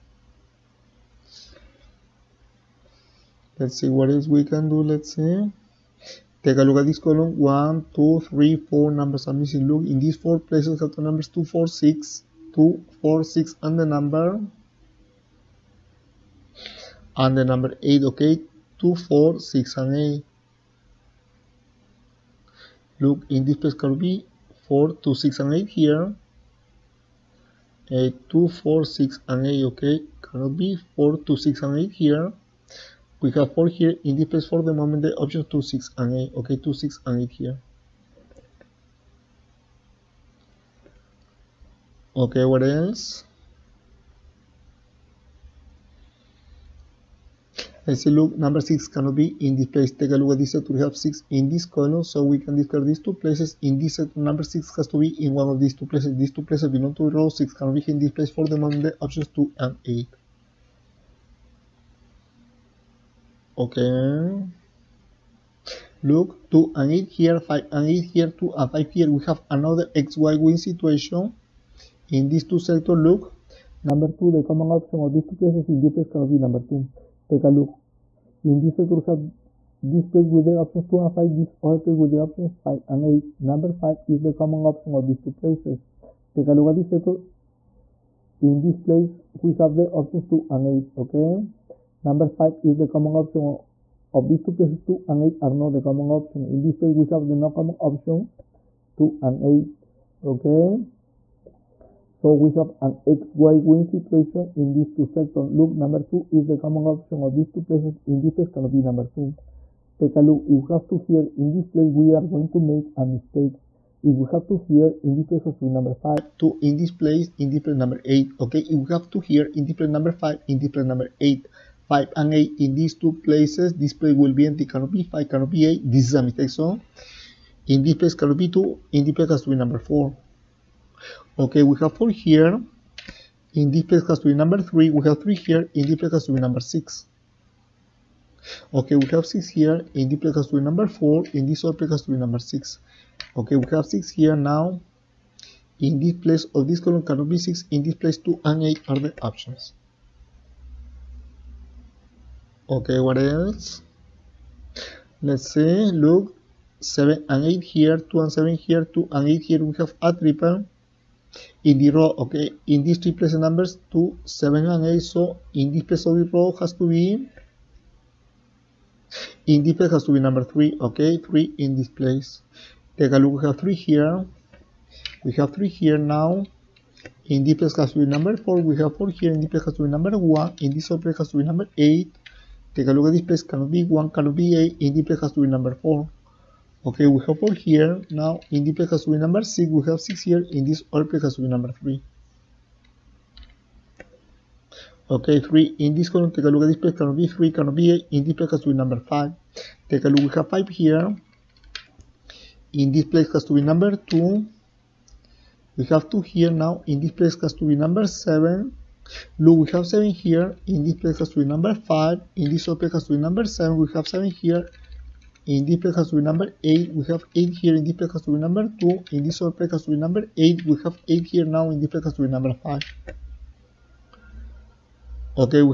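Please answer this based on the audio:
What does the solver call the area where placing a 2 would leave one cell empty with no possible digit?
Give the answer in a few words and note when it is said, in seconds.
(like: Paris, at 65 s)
Mistake zone, at 126 s.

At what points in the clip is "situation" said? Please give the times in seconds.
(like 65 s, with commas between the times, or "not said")
70 s, 103 s.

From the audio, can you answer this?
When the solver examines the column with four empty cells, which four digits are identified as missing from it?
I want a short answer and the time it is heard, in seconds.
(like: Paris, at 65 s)
2, 4, 6 and 8, at 11 s.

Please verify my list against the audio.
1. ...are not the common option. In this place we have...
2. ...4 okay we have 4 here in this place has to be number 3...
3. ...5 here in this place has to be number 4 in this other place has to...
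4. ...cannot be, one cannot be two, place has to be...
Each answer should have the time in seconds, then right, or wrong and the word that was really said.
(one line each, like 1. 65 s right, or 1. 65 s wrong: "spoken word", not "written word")
1. 95 s right
2. 129 s right
3. 139 s wrong: "6", not "5"
4. 183 s wrong: "eight", not "two".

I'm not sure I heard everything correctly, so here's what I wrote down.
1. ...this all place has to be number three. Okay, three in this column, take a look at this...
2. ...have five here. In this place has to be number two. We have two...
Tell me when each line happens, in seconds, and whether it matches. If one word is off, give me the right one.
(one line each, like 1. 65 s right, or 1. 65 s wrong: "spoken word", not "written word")
1. 190 s right
2. 200 s right.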